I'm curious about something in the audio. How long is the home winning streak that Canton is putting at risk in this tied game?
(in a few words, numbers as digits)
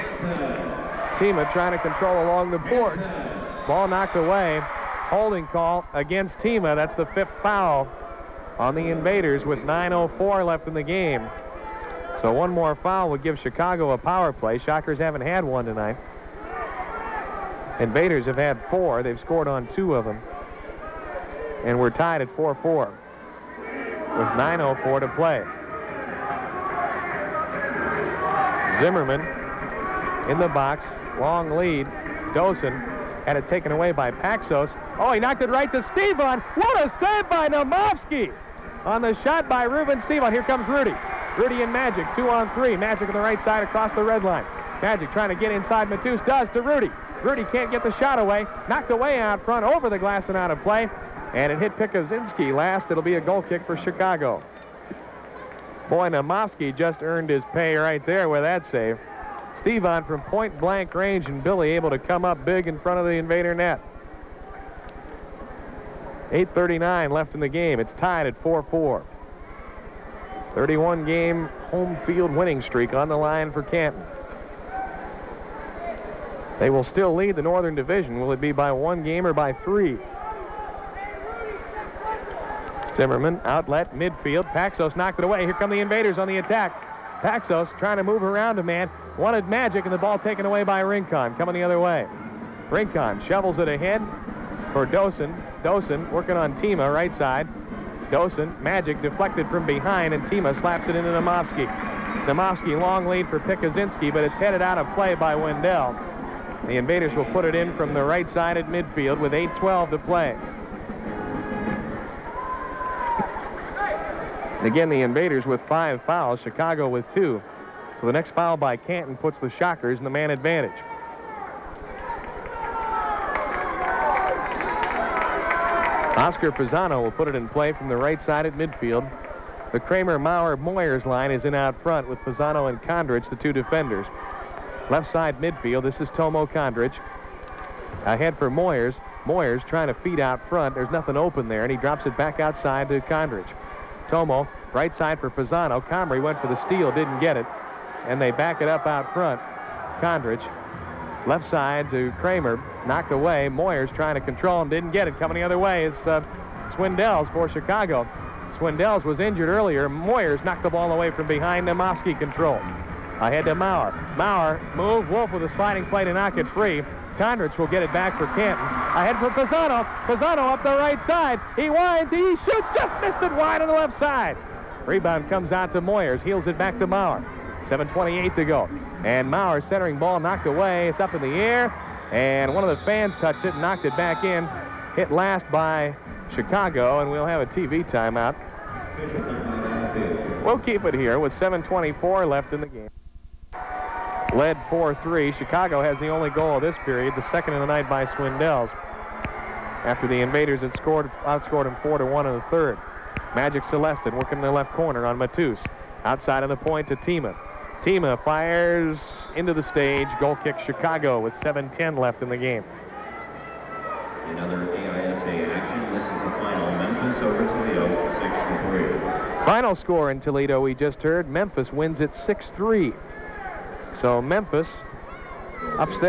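31 games.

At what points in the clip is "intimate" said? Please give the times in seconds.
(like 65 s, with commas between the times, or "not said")
not said.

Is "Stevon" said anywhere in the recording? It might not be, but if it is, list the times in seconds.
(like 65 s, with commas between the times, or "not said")
35 s, 40 s, 59 s.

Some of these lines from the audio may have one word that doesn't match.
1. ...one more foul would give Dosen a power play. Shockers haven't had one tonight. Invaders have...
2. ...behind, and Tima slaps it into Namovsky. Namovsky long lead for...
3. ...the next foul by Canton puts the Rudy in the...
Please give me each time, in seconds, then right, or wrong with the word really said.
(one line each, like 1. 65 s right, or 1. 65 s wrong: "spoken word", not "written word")
1. 12 s wrong: "Chicago", not "Dosen"
2. 99 s right
3. 118 s wrong: "Shockers", not "Rudy".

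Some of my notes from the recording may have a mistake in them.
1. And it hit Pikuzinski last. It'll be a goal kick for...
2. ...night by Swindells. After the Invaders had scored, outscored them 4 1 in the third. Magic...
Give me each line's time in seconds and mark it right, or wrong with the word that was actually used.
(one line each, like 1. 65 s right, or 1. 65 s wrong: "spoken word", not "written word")
1. 51 s right
2. 197 s right.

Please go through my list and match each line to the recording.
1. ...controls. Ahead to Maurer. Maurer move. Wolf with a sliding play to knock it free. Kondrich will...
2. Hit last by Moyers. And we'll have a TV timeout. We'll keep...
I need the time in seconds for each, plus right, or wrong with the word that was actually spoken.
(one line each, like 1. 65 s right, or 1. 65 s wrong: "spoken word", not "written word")
1. 162 s right
2. 184 s wrong: "Chicago", not "Moyers".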